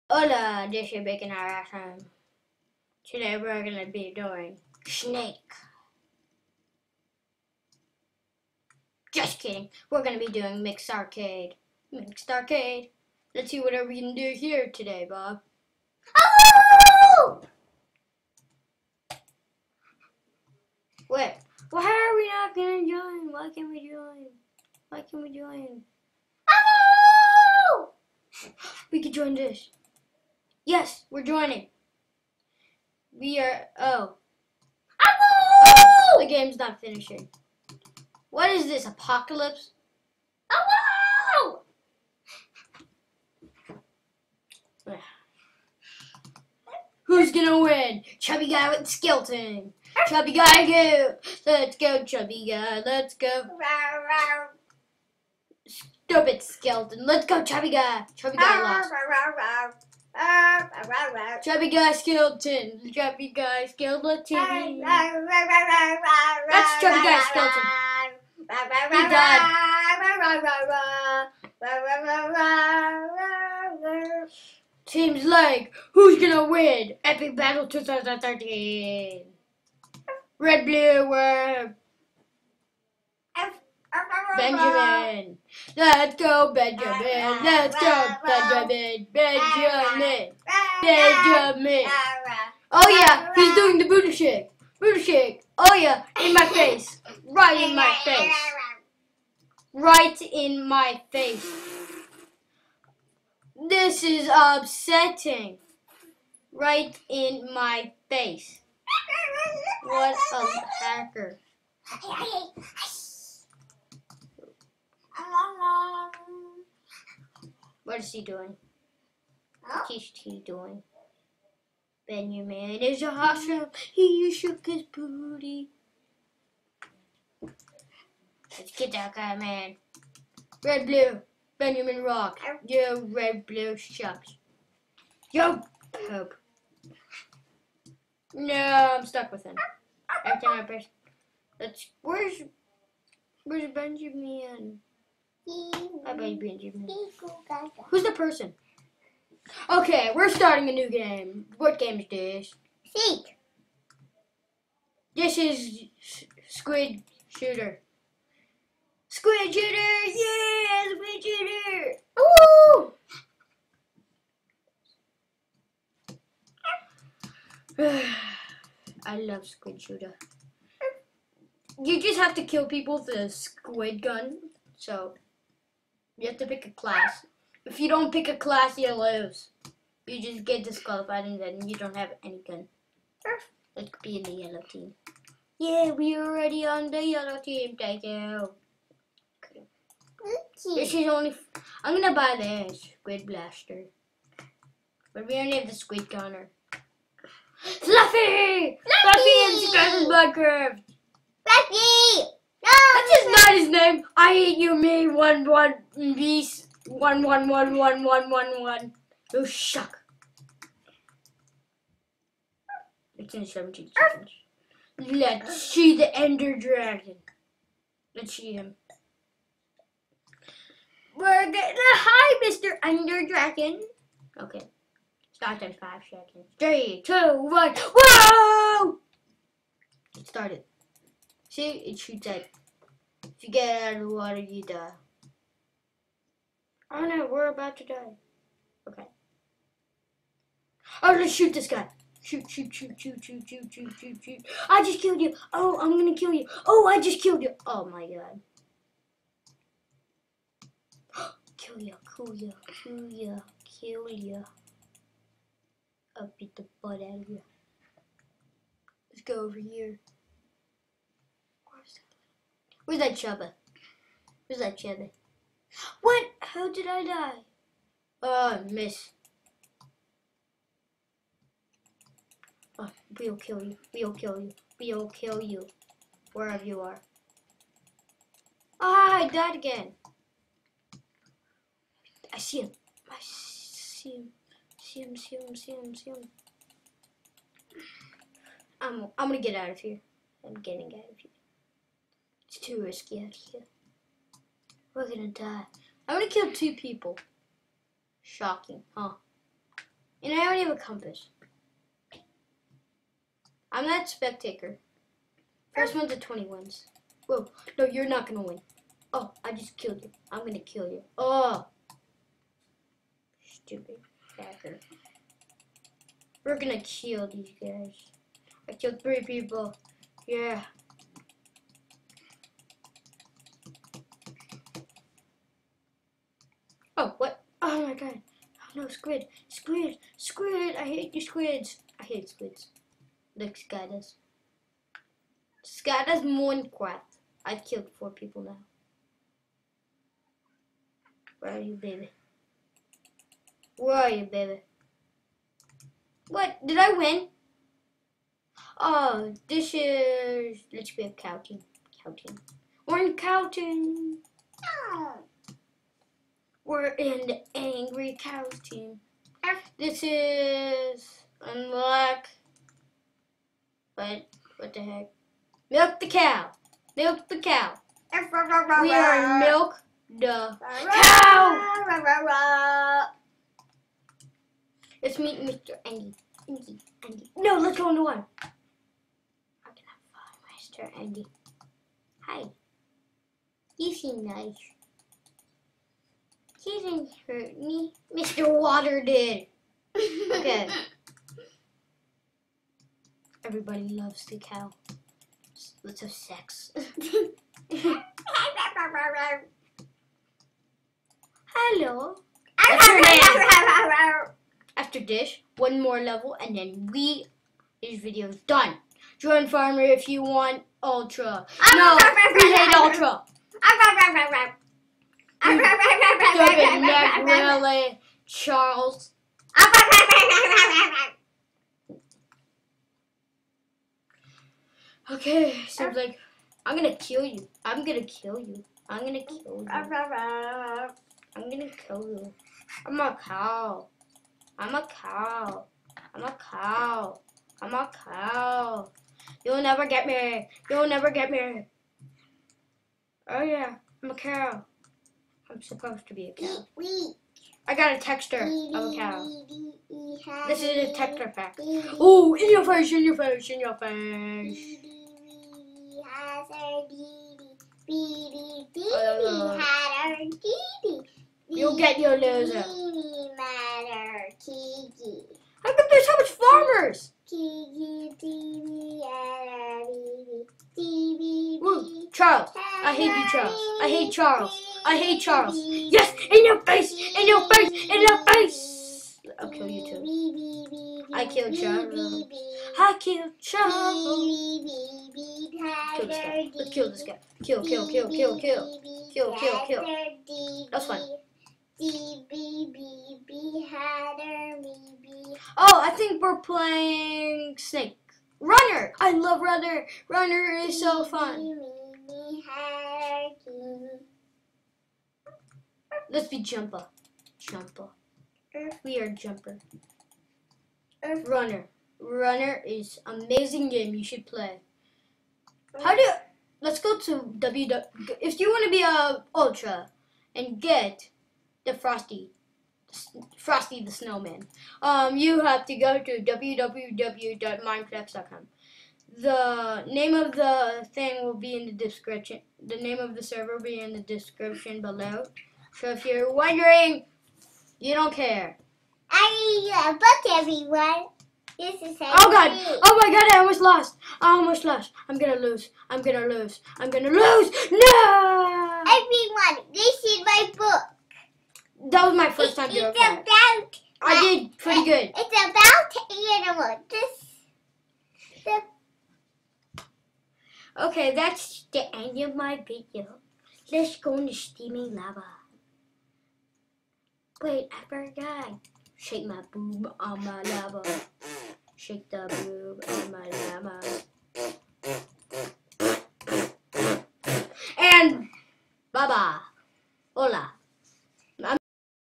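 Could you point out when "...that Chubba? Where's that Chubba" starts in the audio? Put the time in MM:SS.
04:23.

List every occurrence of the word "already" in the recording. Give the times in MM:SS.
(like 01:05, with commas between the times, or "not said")
03:06, 05:00.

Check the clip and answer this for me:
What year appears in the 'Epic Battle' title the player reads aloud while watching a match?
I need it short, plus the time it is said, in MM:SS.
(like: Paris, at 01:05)
2013, at 01:17.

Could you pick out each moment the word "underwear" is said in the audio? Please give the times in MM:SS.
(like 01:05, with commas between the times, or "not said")
not said.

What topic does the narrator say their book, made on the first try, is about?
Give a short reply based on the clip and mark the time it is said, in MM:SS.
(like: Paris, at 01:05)
animals, at 09:16.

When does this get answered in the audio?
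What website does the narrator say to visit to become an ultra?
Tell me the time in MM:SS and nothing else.
08:46.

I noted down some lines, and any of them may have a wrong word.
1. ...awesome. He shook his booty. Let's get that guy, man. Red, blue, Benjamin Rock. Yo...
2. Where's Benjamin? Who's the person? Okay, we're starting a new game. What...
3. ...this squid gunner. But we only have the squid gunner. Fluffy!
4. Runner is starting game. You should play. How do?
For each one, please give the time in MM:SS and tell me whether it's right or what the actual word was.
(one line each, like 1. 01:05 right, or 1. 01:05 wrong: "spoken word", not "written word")
1. 02:03 right
2. 02:23 right
3. 03:12 wrong: "blaster", not "gunner"
4. 08:32 wrong: "amazing", not "starting".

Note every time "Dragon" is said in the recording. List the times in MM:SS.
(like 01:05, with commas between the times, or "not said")
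03:36, 03:43.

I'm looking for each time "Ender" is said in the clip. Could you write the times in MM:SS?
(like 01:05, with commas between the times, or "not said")
03:36, 03:42.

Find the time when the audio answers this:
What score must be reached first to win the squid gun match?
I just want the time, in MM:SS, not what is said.
05:06.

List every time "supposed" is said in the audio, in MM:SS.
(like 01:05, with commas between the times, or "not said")
07:25.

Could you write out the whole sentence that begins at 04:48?
I'm, I'm gonna get out of here.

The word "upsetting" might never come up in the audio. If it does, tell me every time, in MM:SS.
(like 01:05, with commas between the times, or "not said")
01:44.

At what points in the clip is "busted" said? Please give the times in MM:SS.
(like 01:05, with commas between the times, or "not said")
not said.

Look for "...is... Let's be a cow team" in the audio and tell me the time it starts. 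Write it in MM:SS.
05:49.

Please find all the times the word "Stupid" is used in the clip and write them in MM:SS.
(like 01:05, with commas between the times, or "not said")
00:55, 05:13, 06:55.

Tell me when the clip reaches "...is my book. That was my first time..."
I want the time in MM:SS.
09:10.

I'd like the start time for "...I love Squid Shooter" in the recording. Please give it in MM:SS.
02:49.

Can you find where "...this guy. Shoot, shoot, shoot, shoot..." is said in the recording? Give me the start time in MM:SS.
04:01.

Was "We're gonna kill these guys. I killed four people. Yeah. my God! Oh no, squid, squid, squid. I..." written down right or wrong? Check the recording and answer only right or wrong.
wrong.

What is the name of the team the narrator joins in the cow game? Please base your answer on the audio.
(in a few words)
Angry Cows.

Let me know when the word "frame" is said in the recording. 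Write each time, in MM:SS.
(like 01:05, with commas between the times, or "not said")
not said.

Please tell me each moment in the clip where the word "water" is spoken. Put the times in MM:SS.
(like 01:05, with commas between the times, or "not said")
03:54, 06:28.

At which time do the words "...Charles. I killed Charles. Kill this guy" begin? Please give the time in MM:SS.
08:01.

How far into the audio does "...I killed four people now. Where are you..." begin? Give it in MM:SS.
05:37.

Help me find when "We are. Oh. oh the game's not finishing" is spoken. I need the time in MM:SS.
00:33.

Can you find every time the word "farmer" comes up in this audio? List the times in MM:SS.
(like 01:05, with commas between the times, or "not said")
06:49, 07:46.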